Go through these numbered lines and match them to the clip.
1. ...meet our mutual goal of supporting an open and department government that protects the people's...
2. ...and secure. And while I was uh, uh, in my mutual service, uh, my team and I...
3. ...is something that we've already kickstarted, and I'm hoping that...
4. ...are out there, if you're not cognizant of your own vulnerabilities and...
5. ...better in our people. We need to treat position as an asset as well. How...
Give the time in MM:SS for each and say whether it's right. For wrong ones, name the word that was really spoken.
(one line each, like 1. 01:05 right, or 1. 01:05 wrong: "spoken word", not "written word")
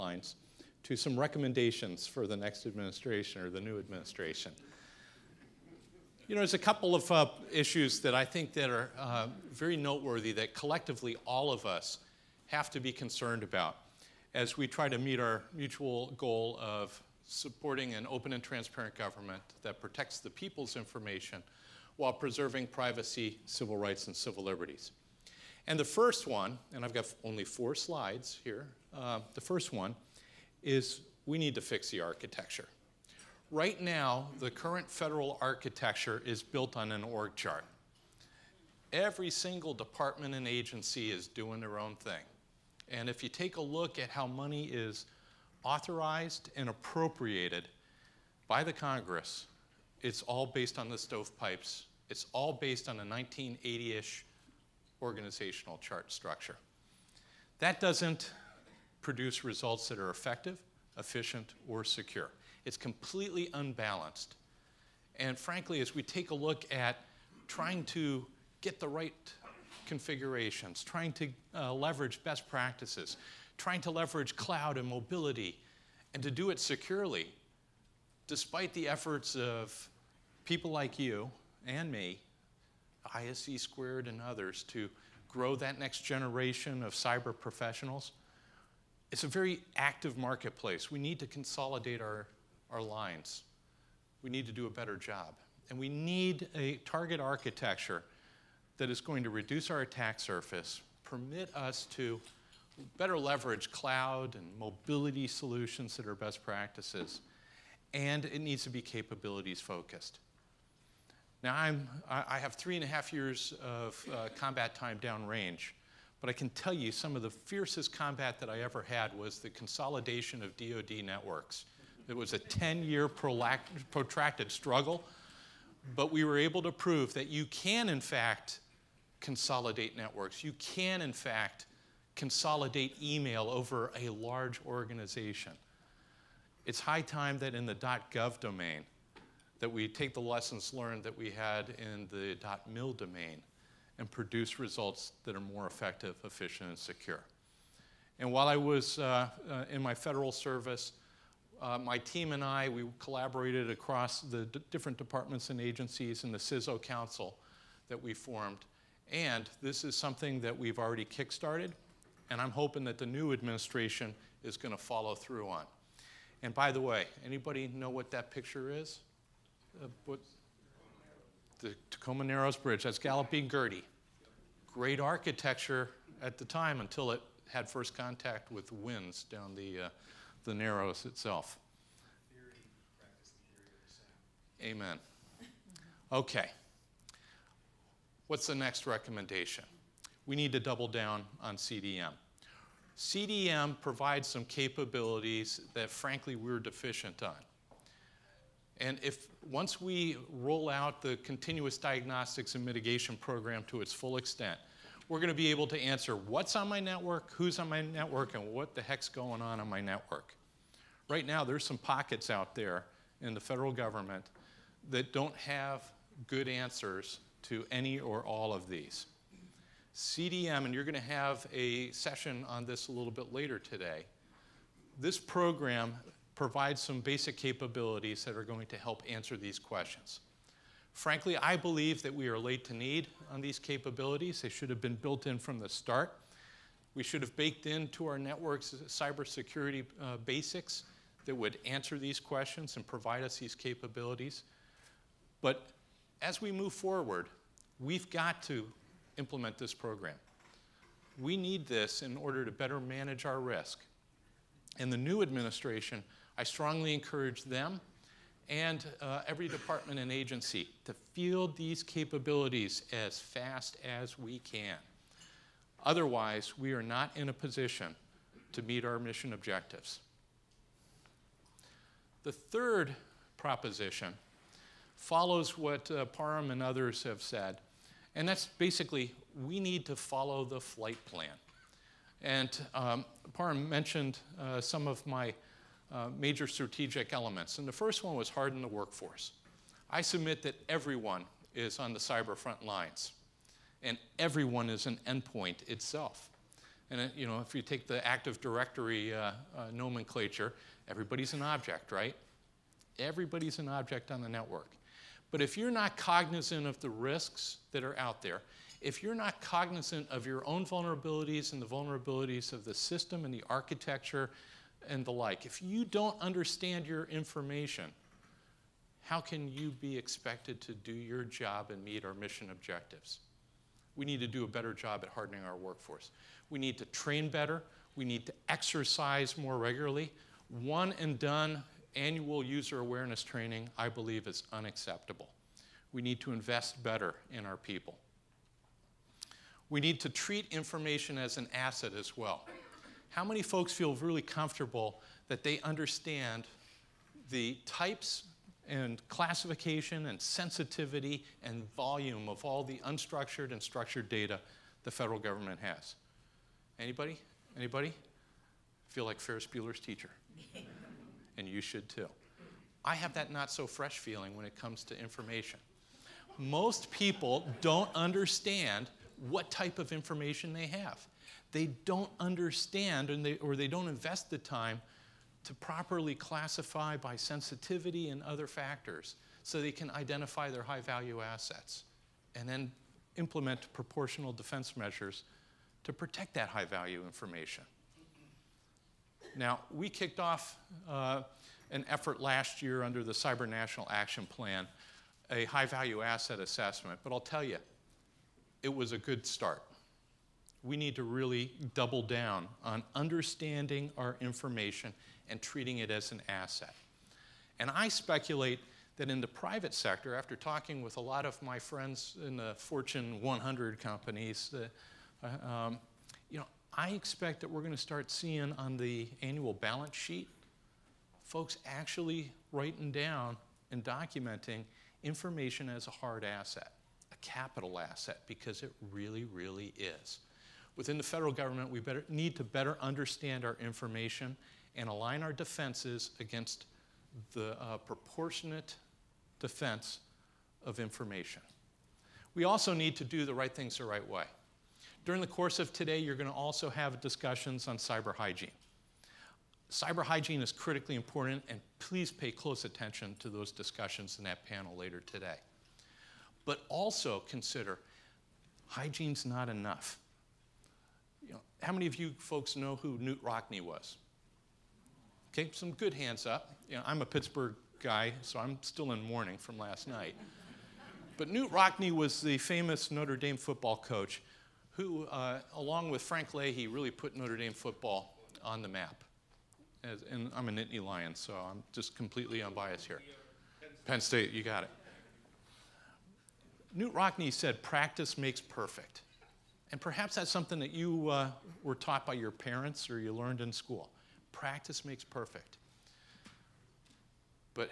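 1. 00:14 wrong: "transparent", not "department"
2. 02:26 wrong: "federal", not "mutual"
3. 02:39 right
4. 05:07 right
5. 05:36 wrong: "information", not "position".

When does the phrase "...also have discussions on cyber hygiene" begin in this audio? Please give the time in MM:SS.
07:26.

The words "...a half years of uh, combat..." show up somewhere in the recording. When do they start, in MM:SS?
01:52.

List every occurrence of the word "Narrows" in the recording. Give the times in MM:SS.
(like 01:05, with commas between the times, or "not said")
02:52, 03:00.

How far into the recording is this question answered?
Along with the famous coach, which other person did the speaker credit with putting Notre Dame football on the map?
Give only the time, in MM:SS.
07:56.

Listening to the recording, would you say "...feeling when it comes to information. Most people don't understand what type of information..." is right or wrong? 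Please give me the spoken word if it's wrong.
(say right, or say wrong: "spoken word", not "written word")
right.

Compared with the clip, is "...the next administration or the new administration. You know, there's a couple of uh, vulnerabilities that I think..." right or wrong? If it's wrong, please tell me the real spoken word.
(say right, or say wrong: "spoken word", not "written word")
wrong: "issues", not "vulnerabilities".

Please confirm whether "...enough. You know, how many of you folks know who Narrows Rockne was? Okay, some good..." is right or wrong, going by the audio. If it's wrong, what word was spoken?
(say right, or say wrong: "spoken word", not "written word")
wrong: "Knute", not "Narrows".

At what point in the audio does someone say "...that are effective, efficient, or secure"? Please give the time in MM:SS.
00:59.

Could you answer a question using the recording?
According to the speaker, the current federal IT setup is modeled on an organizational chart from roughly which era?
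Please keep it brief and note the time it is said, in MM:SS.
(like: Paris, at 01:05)
1980, at 00:53.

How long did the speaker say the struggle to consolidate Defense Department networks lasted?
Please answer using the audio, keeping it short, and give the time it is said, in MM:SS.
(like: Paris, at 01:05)
10 years, at 02:02.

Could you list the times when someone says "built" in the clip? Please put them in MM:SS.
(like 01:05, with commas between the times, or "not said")
00:36, 03:54.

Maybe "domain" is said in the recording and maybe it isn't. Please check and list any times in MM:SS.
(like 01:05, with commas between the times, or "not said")
02:18, 02:22.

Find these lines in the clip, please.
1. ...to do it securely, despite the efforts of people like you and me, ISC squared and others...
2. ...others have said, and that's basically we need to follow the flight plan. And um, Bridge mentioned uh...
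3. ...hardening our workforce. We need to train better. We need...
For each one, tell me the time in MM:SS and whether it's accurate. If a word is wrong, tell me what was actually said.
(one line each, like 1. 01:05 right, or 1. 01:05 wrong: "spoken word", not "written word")
1. 01:16 right
2. 04:36 wrong: "Parham", not "Bridge"
3. 05:25 right.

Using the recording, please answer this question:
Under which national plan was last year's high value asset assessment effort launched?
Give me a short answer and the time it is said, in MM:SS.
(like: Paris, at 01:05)
Cyber National Action Plan, at 06:33.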